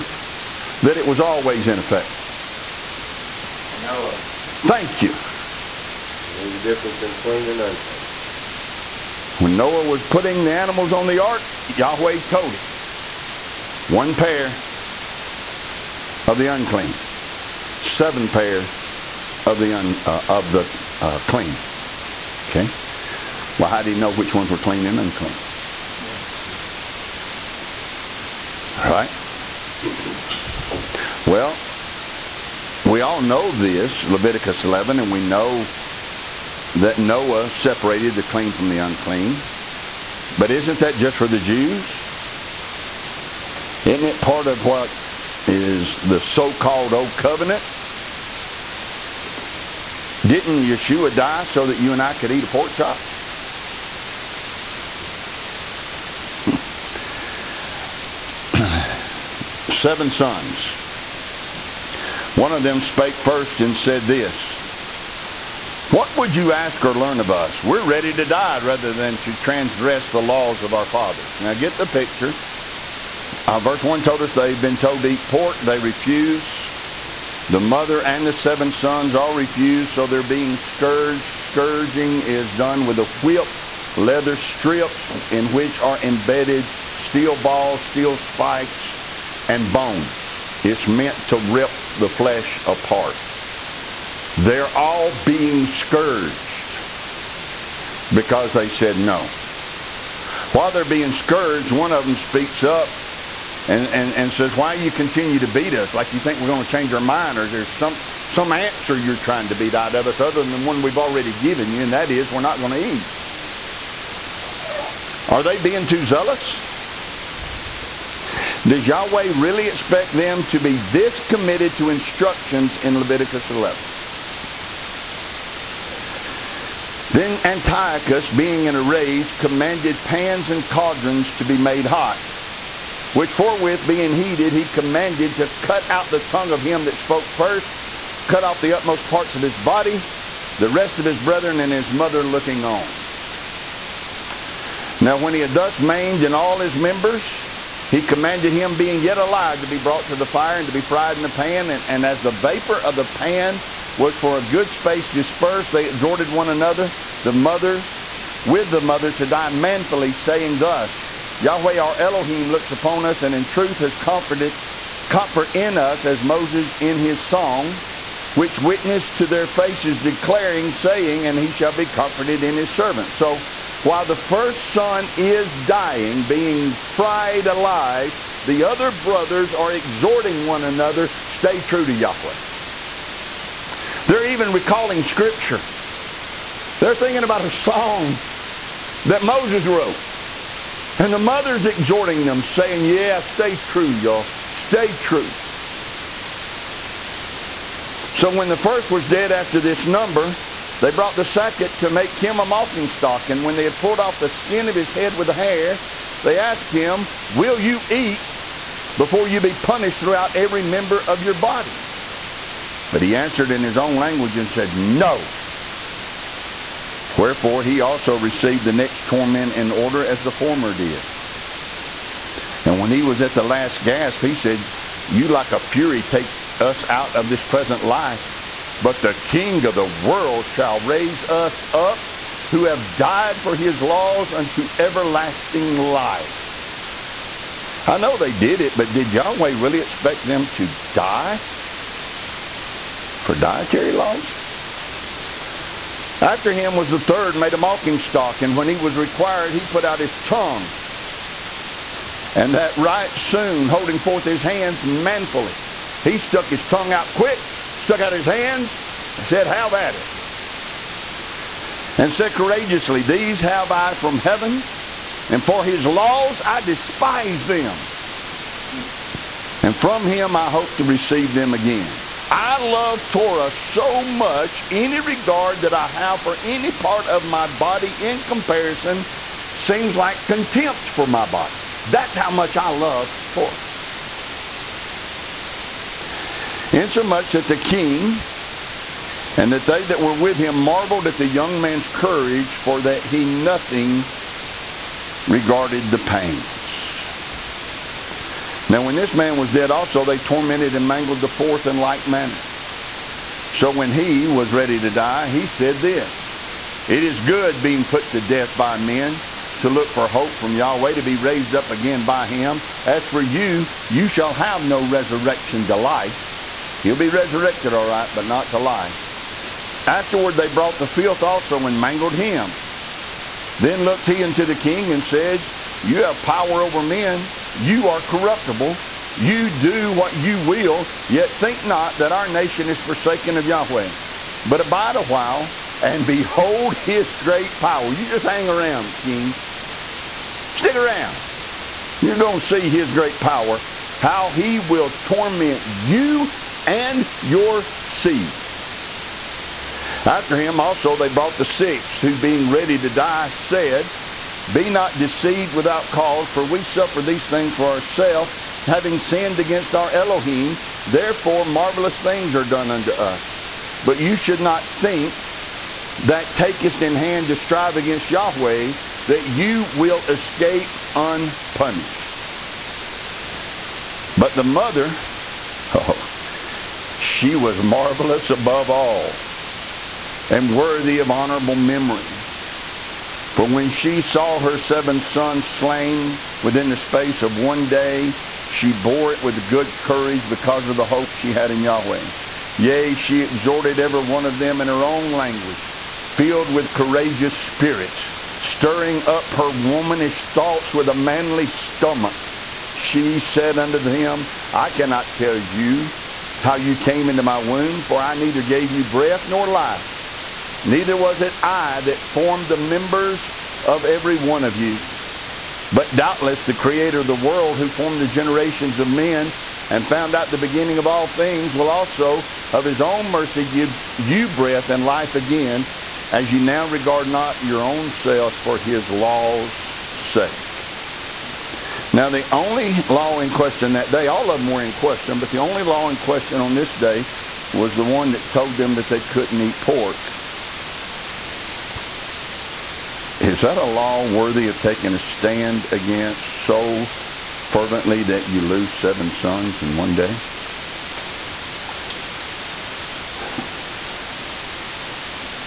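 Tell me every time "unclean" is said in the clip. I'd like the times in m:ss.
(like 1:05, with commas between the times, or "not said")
0:07, 0:16, 0:24, 0:38.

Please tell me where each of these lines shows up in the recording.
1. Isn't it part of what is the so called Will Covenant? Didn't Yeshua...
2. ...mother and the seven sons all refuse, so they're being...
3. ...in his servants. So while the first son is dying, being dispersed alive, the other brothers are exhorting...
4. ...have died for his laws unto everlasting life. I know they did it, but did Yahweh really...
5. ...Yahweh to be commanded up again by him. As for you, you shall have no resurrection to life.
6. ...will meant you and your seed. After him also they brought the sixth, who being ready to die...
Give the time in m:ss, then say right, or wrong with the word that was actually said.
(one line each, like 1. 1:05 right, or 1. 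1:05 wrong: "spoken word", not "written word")
1. 0:43 wrong: "Old", not "Will"
2. 1:17 right
3. 2:52 wrong: "fried", not "dispersed"
4. 3:52 right
5. 5:10 wrong: "raised", not "commanded"
6. 5:44 wrong: "torment", not "meant".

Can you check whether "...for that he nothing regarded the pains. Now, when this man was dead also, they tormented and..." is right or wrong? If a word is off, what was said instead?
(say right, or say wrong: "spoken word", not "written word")
right.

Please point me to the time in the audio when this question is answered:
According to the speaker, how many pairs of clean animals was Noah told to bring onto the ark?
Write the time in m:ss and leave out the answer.
0:17.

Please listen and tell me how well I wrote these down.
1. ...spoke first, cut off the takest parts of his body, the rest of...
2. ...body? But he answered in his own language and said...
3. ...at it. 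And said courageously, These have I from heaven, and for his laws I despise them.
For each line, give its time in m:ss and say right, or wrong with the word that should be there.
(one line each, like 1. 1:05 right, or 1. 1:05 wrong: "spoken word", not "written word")
1. 2:16 wrong: "utmost", not "takest"
2. 3:31 right
3. 4:19 right.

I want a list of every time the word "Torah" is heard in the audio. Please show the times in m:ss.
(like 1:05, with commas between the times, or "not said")
4:33, 4:43.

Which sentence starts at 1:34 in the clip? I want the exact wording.
They're all being scourged because they said no.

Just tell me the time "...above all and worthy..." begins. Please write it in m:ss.
6:18.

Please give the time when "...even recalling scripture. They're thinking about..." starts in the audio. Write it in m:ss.
3:04.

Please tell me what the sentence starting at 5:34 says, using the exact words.
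But abide a while and behold his great power.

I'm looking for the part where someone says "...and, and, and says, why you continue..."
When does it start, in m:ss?
1:43.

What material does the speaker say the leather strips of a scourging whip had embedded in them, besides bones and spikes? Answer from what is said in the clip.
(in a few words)
steel balls.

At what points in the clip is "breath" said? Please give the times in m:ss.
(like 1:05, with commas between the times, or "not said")
6:48, 7:04.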